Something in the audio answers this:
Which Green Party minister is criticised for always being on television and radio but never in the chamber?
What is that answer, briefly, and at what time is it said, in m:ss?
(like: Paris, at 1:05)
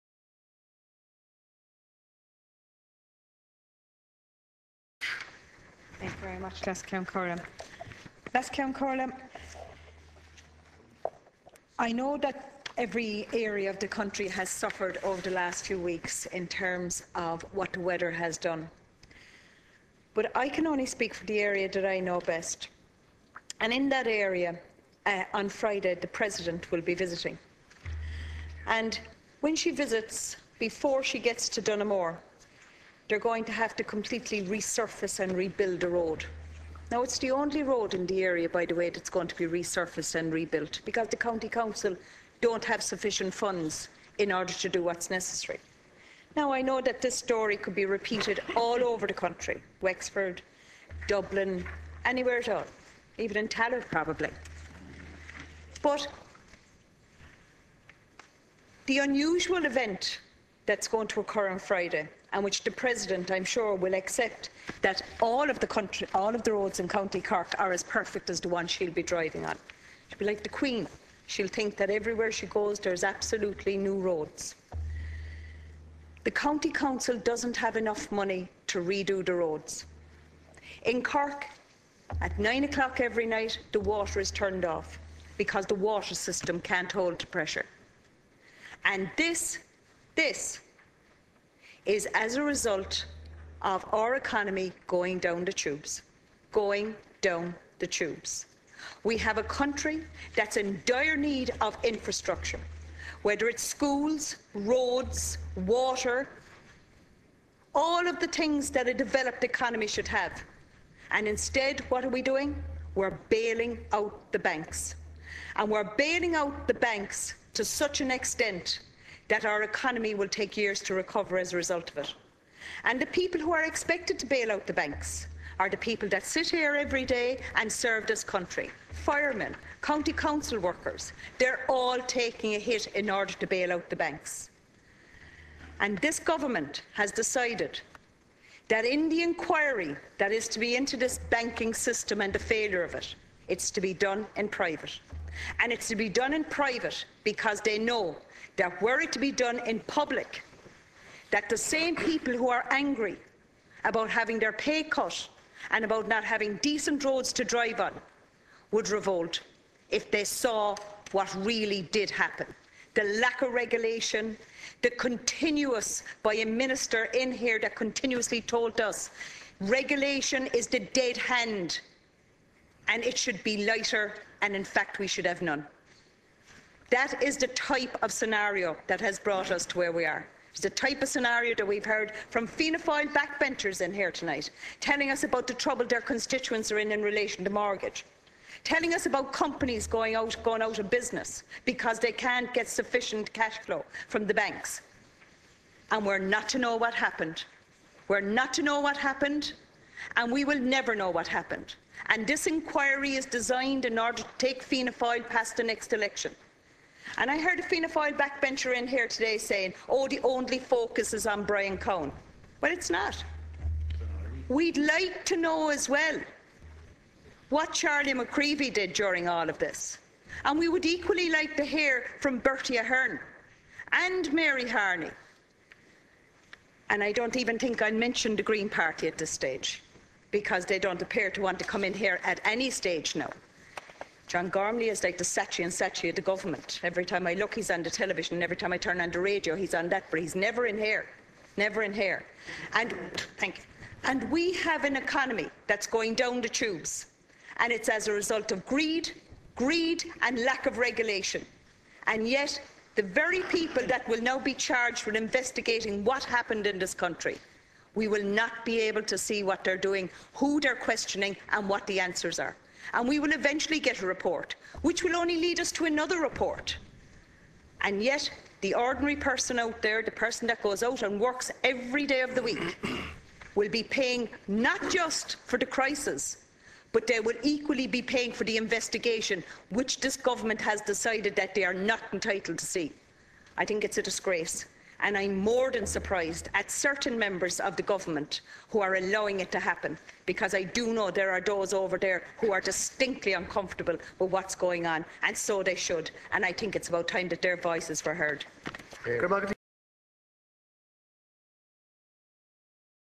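John Gormley, at 3:54.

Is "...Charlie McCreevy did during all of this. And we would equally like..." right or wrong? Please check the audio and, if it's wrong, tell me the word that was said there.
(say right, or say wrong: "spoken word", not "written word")
right.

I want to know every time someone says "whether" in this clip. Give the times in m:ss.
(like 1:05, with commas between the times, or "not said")
1:43.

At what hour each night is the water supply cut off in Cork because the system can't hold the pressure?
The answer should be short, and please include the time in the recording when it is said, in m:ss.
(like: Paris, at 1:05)
9 o'clock, at 1:22.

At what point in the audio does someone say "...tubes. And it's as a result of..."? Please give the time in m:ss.
4:06.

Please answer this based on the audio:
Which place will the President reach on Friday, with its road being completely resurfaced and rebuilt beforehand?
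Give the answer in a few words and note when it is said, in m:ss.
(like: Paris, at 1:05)
Dunamore, at 0:31.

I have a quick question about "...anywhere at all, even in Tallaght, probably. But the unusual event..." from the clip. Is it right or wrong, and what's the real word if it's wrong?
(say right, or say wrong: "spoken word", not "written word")
right.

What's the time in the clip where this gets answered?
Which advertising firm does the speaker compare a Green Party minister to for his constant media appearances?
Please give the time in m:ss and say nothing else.
3:55.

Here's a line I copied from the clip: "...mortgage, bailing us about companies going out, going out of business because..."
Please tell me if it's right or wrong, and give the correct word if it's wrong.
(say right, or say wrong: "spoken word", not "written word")
wrong: "telling", not "bailing".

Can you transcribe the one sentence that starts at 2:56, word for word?
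That is the type of scenario that has brought us to where we are.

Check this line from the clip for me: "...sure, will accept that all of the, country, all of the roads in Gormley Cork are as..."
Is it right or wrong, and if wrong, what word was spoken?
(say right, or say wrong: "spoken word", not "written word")
wrong: "County", not "Gormley".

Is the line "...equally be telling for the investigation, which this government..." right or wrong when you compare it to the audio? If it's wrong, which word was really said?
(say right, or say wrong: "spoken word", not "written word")
wrong: "paying", not "telling".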